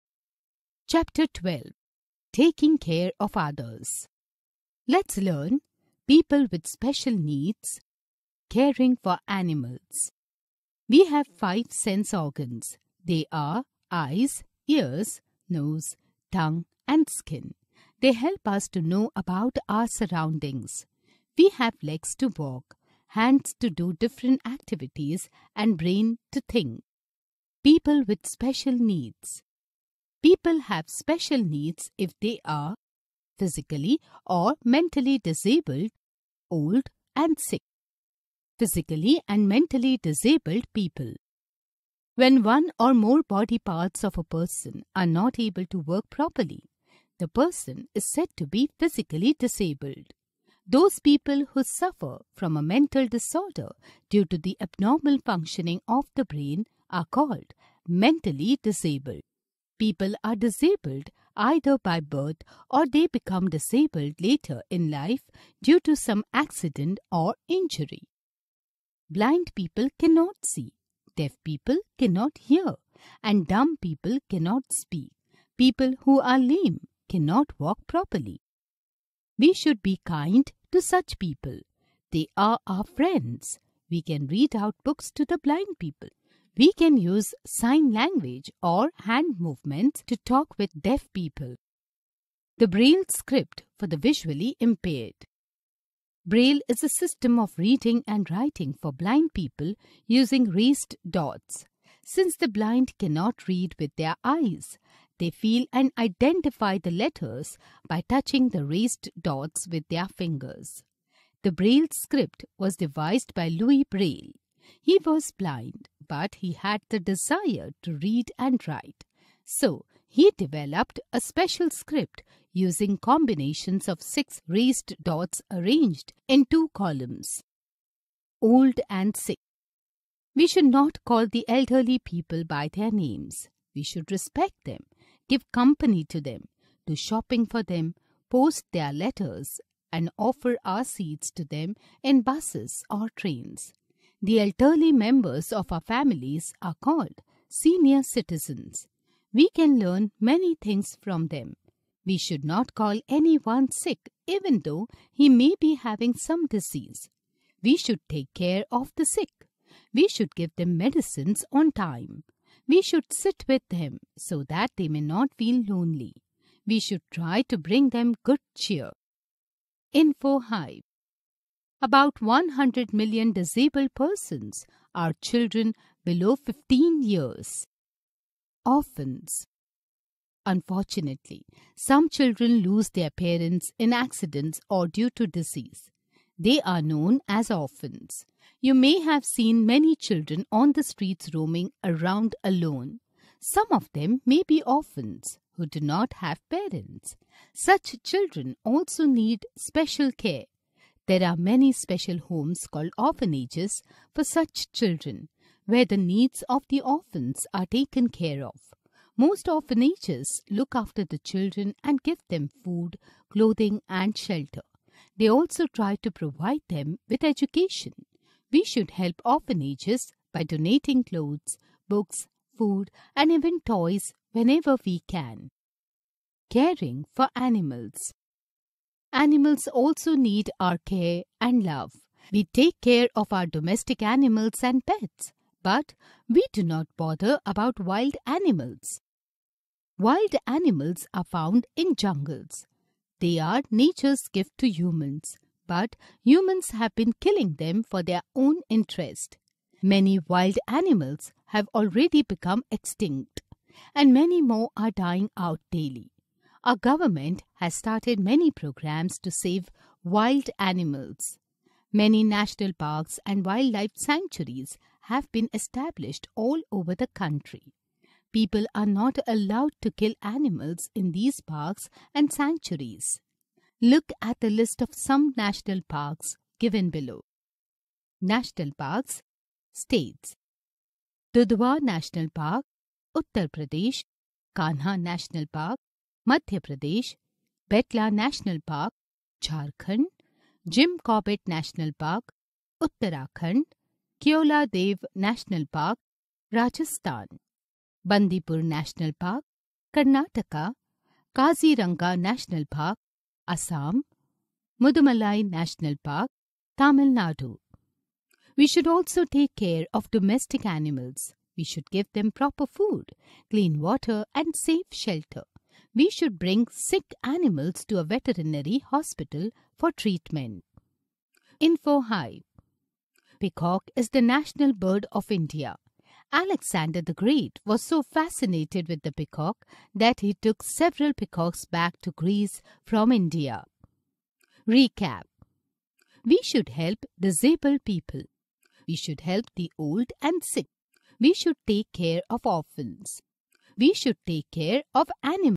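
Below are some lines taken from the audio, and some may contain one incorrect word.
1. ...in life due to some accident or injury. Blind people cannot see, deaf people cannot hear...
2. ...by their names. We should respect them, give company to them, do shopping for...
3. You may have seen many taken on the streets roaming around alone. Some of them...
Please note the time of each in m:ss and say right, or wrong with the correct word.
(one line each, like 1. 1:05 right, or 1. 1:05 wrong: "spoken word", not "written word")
1. 1:04 right
2. 2:12 right
3. 3:08 wrong: "children", not "taken".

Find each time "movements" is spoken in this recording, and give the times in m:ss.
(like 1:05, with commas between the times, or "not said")
1:29.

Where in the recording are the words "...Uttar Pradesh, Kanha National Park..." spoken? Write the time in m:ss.
4:43.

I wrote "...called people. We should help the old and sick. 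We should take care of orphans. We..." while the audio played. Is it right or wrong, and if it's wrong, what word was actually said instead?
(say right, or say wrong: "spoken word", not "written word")
wrong: "disabled", not "called".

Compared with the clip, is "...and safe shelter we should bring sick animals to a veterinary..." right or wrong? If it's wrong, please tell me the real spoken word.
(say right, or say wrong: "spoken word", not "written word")
right.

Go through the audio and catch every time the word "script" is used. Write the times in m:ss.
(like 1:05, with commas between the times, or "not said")
1:33, 1:51, 2:01.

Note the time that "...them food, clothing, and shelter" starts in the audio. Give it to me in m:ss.
3:32.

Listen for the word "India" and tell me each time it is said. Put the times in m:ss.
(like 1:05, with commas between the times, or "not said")
5:25, 5:33.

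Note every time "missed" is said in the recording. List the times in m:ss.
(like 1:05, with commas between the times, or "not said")
not said.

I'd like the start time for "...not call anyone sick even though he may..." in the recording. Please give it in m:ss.
2:32.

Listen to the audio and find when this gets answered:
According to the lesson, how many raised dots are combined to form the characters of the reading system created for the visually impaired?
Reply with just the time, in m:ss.
2:04.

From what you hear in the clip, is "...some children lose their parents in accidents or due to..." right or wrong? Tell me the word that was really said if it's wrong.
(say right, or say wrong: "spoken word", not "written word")
right.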